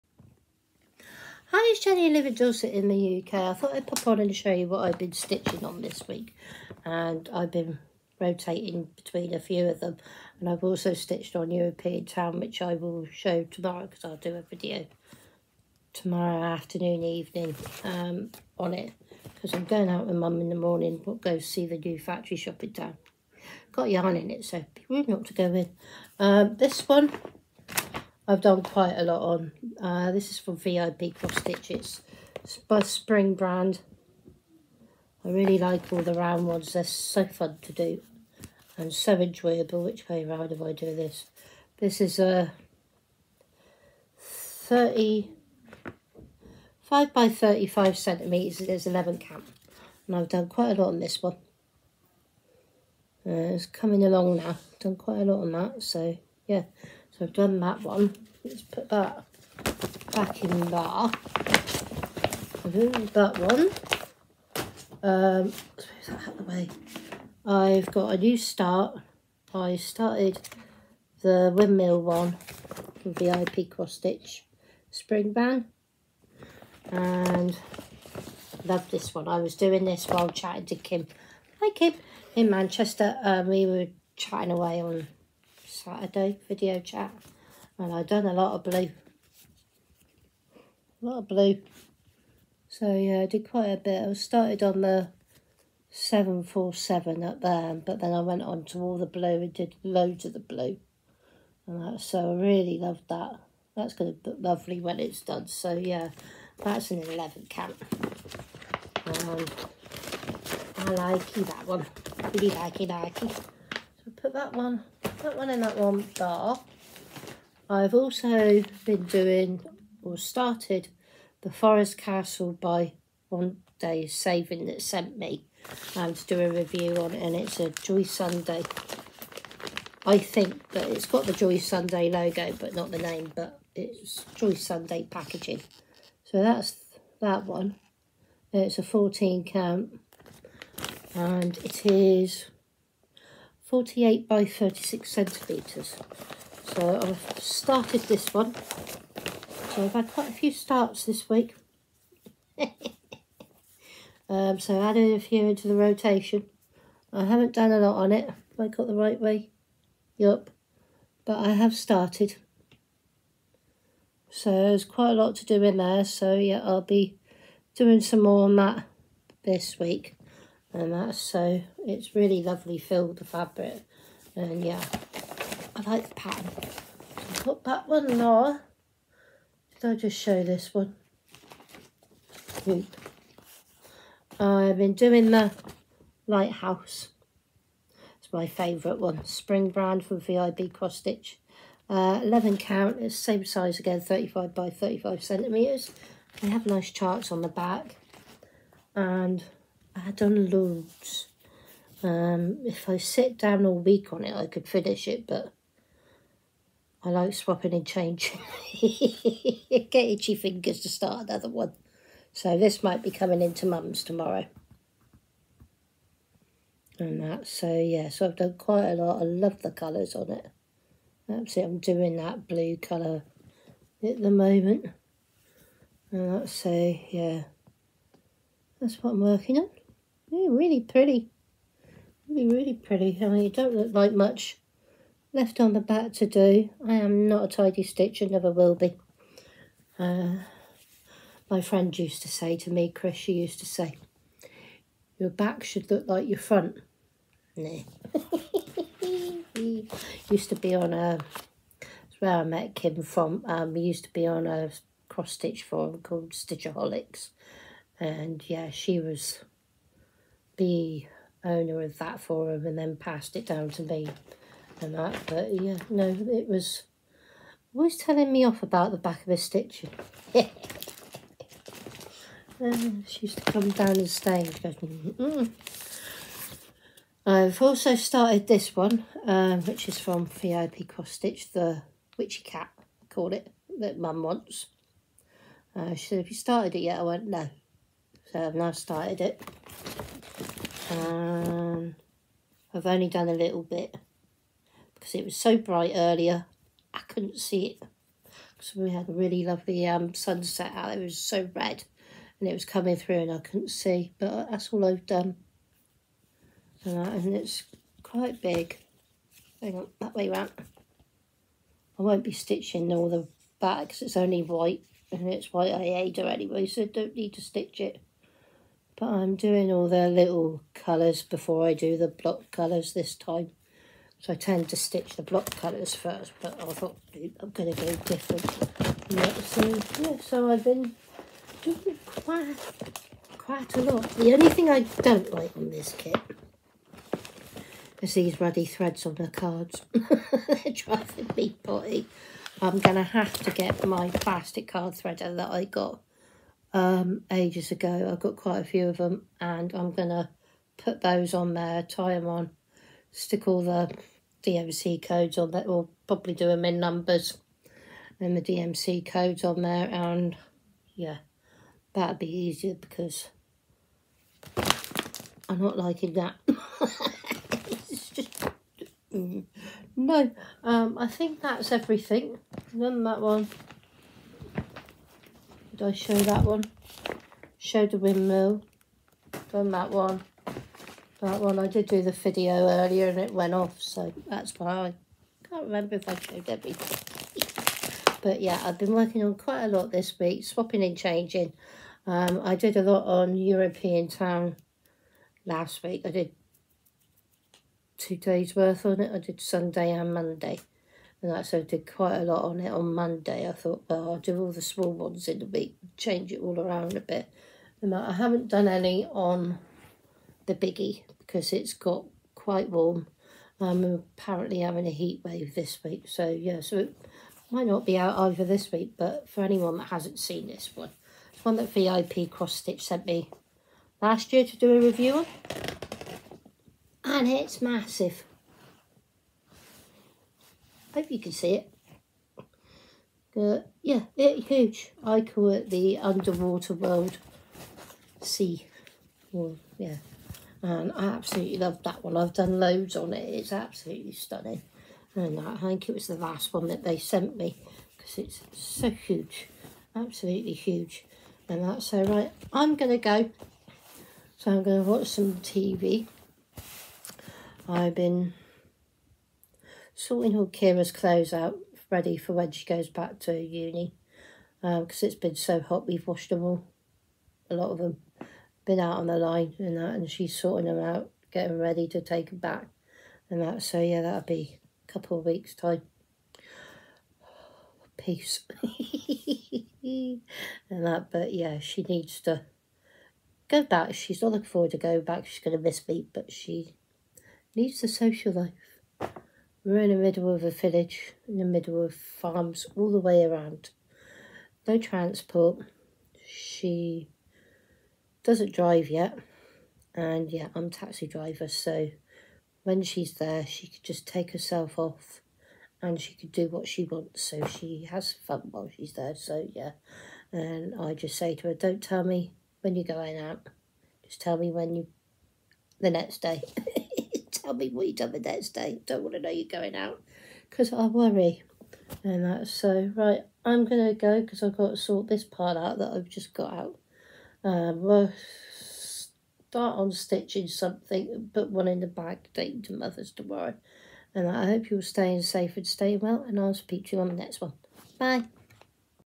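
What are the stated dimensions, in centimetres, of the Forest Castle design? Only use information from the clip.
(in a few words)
48 by 36.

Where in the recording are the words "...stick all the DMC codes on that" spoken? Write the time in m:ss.
5:53.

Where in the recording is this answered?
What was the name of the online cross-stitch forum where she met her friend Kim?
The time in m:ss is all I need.
4:16.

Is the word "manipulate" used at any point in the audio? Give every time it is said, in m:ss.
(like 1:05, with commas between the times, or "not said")
not said.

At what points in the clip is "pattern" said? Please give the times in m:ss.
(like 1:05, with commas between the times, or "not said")
2:56.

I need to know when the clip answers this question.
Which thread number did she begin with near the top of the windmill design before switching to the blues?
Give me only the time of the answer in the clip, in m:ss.
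1:35.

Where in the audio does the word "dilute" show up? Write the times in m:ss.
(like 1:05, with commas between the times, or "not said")
not said.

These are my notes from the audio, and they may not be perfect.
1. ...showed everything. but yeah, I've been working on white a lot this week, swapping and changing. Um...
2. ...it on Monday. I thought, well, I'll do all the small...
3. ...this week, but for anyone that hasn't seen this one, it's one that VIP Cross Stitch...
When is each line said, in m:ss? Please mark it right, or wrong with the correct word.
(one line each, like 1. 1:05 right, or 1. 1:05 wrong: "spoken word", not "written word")
1. 6:26 wrong: "quite", not "white"
2. 6:42 right
3. 6:58 right.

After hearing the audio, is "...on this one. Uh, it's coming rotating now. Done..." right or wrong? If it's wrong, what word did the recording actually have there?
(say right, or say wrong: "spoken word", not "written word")
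wrong: "along", not "rotating".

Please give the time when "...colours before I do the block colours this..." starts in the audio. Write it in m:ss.
5:20.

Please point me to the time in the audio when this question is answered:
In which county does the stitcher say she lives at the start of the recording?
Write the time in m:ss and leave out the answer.
0:02.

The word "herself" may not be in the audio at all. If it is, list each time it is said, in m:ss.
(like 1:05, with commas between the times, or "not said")
8:24.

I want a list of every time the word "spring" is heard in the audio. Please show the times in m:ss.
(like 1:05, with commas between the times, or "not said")
0:32, 1:14, 3:09.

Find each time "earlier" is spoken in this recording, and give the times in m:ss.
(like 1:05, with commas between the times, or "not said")
4:55, 6:22.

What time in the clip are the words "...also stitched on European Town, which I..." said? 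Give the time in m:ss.
0:10.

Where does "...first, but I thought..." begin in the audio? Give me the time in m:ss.
5:25.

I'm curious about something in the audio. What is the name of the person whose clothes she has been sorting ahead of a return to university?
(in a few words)
Kira.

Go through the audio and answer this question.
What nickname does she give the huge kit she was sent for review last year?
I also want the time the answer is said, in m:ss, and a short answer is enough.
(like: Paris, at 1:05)
underwater world sea, at 7:15.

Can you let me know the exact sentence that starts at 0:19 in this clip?
Because I'm going out with mum in the morning, but go see the new factory shop in town.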